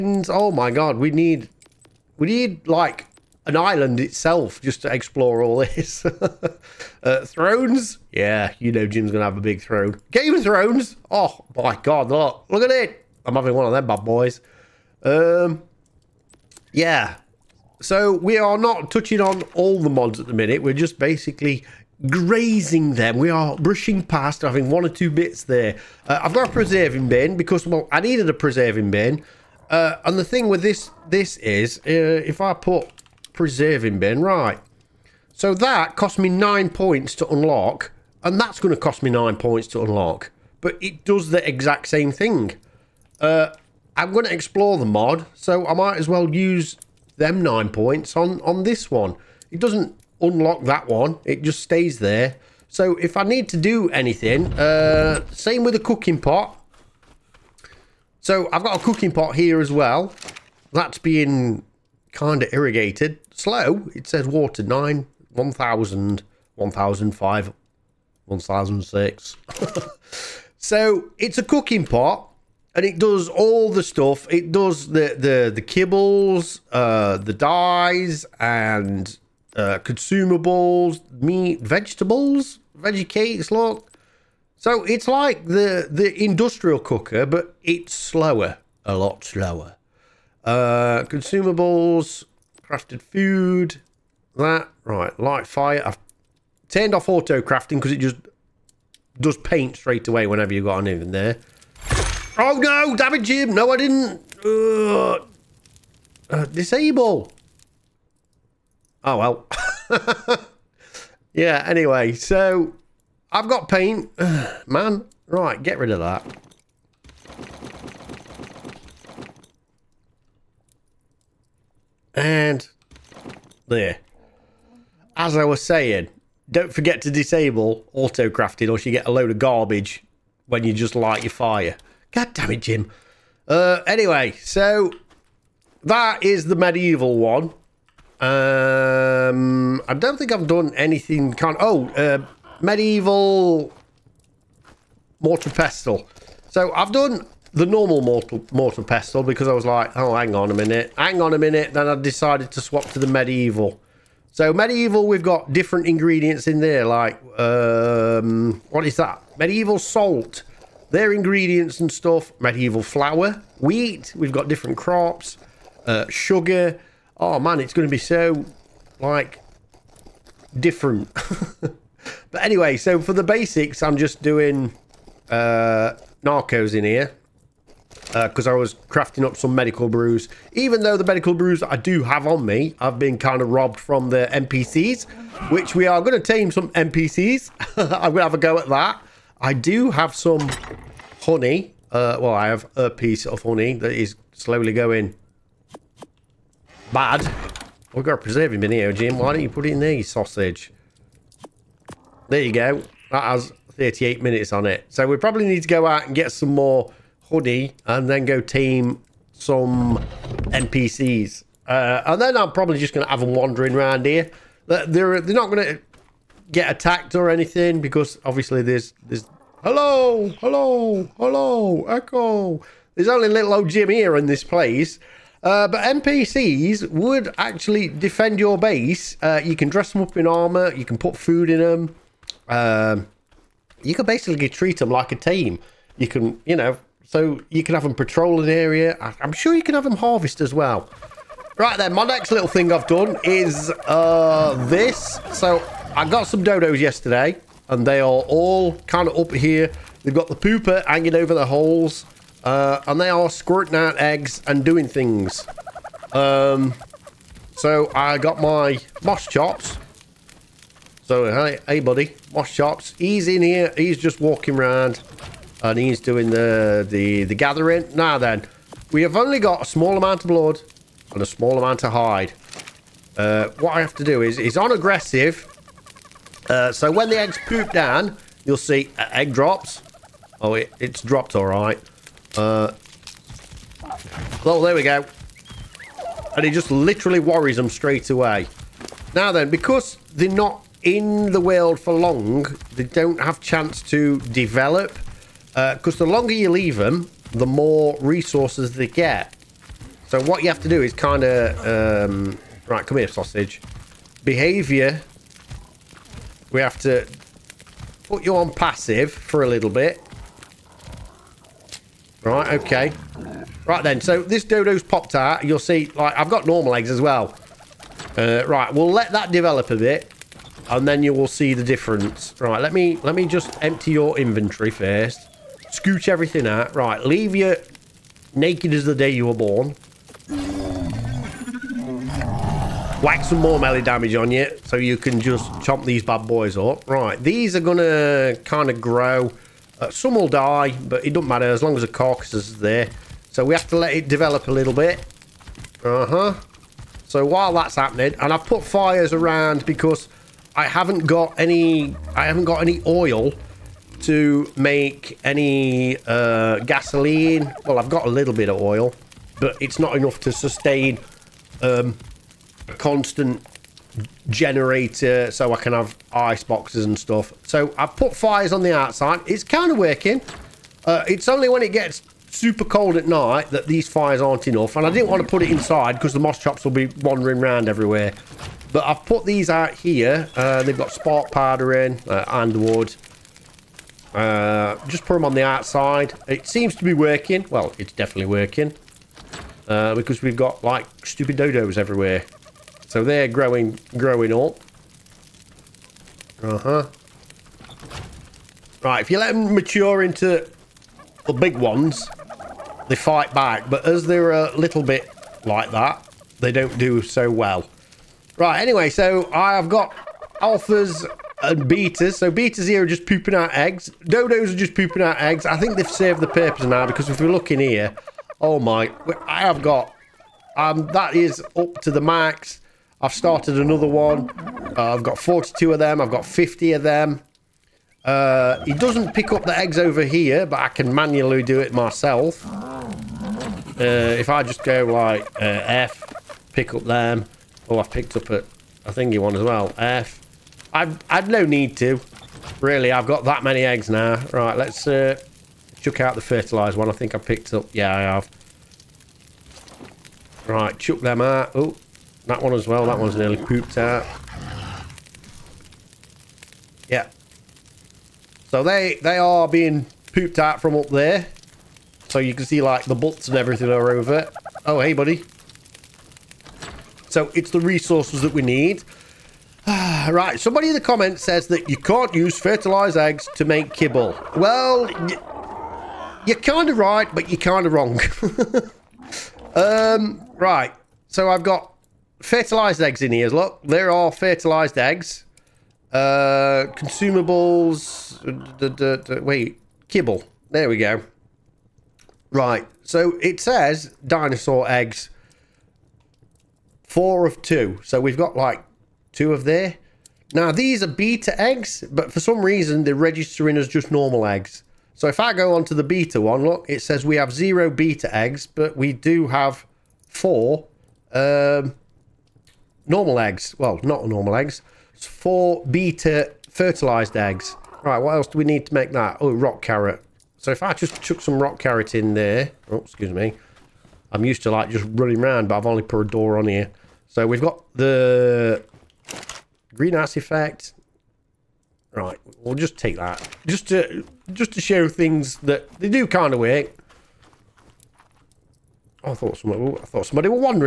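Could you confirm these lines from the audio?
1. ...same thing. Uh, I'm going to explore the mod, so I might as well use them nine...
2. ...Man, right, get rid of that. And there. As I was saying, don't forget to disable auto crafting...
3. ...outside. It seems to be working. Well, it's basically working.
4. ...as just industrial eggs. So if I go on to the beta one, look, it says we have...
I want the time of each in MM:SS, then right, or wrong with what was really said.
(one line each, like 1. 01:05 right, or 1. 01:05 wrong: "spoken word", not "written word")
1. 00:41 right
2. 01:54 right
3. 06:25 wrong: "definitely", not "basically"
4. 08:23 wrong: "normal", not "industrial".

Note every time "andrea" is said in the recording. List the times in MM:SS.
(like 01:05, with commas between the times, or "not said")
not said.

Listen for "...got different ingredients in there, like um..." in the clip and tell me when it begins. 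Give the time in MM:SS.
02:35.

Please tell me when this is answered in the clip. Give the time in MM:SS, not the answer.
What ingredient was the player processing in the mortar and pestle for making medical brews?
02:56.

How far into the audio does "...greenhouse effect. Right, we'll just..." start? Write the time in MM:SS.
08:49.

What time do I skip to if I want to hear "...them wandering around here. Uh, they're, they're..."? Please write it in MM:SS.
03:33.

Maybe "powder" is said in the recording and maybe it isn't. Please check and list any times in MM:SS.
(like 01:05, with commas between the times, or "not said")
06:21.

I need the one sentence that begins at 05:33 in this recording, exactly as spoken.
Whack some more melee damage on you, so you can just chomp these bad boys up.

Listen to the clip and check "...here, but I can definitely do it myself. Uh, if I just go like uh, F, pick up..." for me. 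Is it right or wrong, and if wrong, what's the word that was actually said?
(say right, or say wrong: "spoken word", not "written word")
wrong: "manually", not "definitely".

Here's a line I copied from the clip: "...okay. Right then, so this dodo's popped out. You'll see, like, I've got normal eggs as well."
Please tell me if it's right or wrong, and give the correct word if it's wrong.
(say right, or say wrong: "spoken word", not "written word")
right.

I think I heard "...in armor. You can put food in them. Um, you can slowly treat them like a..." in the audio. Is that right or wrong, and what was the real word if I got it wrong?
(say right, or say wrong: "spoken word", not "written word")
wrong: "basically", not "slowly".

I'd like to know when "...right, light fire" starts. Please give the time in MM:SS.
01:34.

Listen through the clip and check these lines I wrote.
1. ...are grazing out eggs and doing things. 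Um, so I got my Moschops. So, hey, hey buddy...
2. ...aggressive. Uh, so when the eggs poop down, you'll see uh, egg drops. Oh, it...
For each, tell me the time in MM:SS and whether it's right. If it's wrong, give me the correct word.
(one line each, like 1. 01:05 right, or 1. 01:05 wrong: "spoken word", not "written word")
1. 04:13 wrong: "squirting", not "grazing"
2. 04:34 right.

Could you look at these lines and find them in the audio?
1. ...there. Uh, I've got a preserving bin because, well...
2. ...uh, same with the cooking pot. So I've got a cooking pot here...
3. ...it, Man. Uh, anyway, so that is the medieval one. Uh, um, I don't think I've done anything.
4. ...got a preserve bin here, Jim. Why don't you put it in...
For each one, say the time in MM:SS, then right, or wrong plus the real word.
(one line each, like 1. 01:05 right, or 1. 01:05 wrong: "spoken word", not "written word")
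1. 00:25 right
2. 00:54 right
3. 02:12 wrong: "Jim", not "Man"
4. 03:18 right.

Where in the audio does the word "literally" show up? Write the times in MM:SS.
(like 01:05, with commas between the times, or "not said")
04:46.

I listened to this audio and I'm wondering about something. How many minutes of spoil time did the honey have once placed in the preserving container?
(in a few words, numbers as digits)
38.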